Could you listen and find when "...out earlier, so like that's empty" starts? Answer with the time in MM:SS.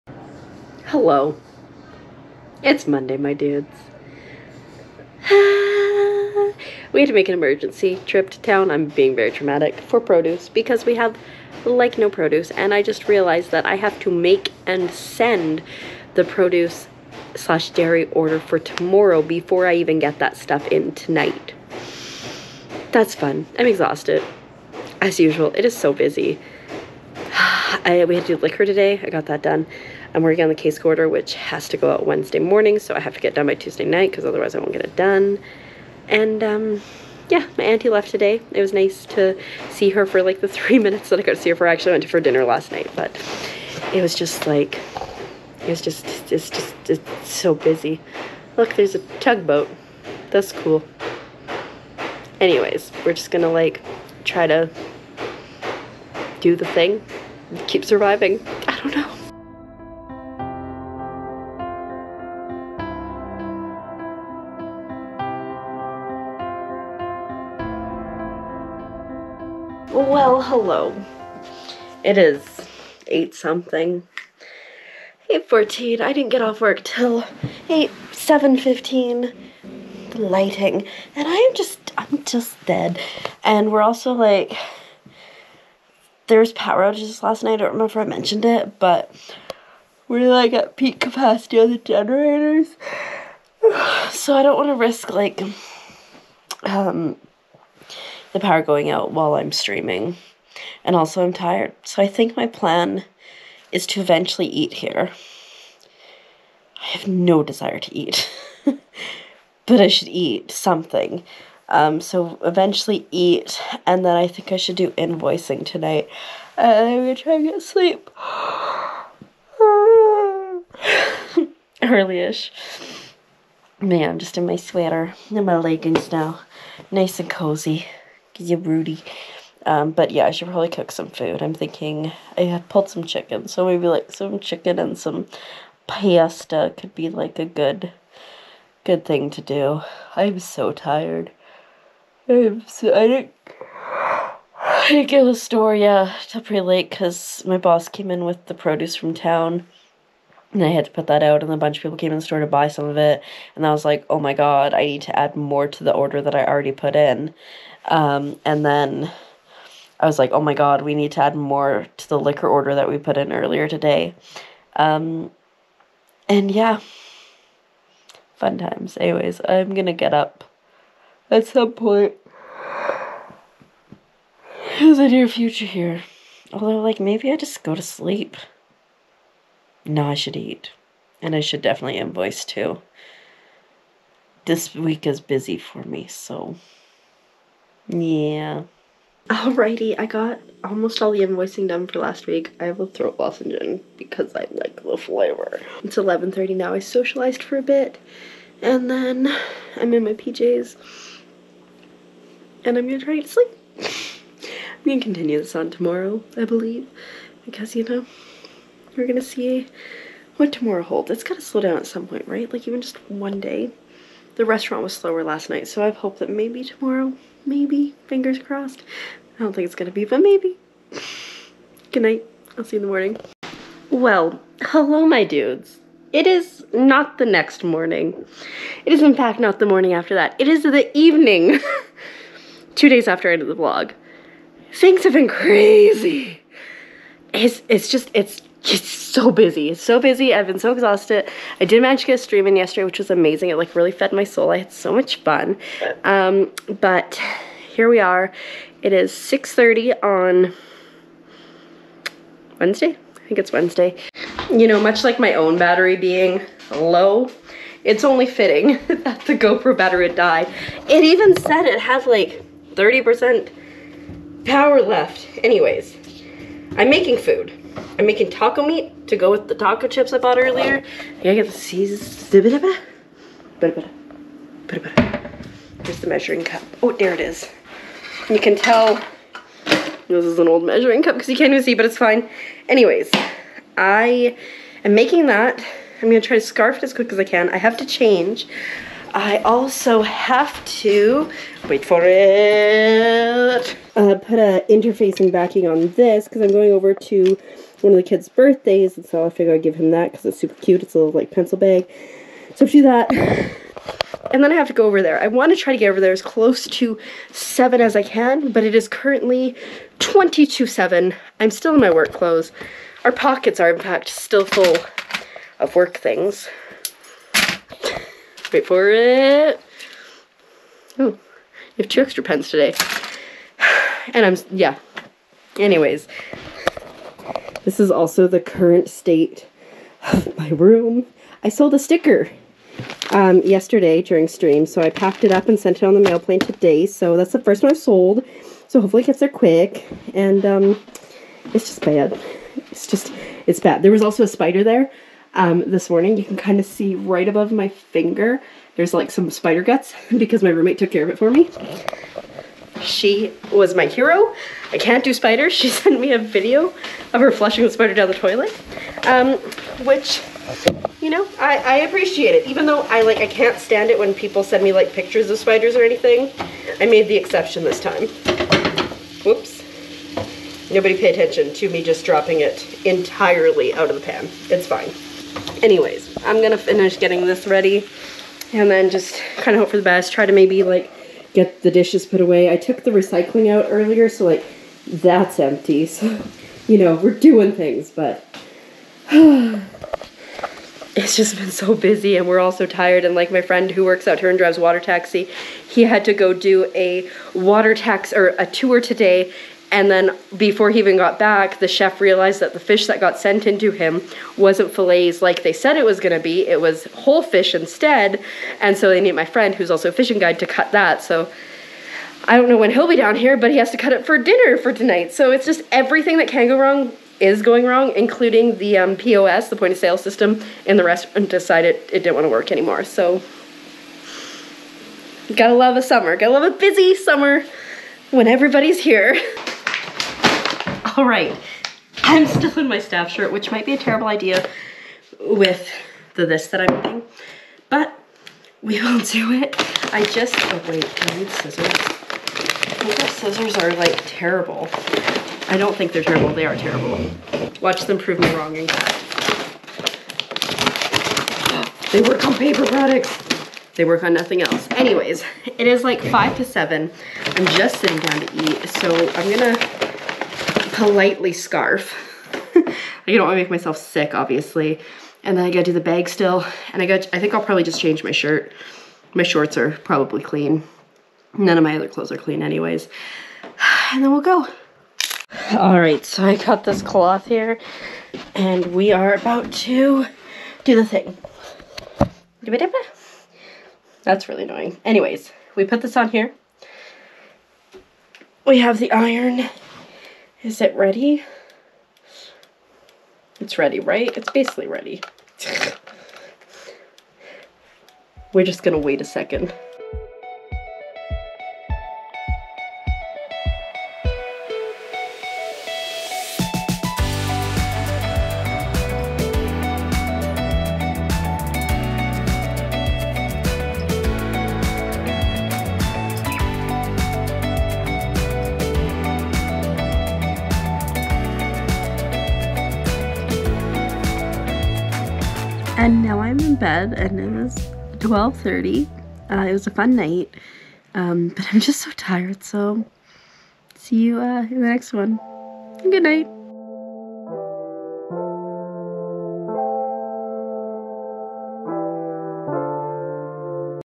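06:23.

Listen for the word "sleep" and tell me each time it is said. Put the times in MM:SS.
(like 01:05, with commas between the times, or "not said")
01:57, 02:57, 03:23.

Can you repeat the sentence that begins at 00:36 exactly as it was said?
And um, yeah, my auntie left today.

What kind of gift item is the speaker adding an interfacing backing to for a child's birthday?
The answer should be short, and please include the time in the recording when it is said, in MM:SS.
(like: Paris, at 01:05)
pencil bag, at 05:01.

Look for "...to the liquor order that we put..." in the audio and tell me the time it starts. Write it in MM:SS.
02:41.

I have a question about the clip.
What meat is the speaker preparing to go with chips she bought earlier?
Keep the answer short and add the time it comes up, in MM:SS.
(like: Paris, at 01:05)
taco meat, at 04:28.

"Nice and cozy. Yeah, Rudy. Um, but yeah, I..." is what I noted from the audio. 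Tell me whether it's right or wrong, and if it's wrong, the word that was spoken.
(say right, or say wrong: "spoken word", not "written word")
right.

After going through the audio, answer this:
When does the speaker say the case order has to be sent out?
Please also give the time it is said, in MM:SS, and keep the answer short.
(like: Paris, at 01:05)
Wednesday morning, at 00:32.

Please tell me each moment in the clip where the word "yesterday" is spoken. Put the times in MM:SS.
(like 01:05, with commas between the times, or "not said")
04:02, 05:33.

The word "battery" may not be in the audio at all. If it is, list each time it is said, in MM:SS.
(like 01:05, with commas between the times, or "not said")
04:15, 04:19.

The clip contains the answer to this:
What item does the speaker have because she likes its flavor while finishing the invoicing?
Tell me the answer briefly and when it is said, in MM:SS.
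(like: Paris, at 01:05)
throat lozenge, at 03:12.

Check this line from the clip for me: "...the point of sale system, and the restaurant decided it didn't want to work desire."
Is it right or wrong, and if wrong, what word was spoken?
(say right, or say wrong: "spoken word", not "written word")
wrong: "anymore", not "desire".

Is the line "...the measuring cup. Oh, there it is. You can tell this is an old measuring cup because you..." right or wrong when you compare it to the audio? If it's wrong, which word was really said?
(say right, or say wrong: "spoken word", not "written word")
right.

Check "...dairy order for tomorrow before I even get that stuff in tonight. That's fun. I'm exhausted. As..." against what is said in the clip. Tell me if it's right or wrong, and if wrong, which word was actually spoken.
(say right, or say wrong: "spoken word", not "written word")
right.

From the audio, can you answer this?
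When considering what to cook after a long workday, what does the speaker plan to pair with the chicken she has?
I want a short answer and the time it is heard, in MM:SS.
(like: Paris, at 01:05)
pasta, at 02:15.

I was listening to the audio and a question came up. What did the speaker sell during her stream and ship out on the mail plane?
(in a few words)
a sticker.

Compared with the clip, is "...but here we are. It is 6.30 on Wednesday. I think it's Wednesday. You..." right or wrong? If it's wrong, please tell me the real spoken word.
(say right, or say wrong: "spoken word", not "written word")
right.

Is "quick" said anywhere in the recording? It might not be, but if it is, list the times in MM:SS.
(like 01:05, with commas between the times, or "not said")
04:46, 05:39.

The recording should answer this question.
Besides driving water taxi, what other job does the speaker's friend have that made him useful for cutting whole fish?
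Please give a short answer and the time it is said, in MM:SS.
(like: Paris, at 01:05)
fishing guide, at 06:49.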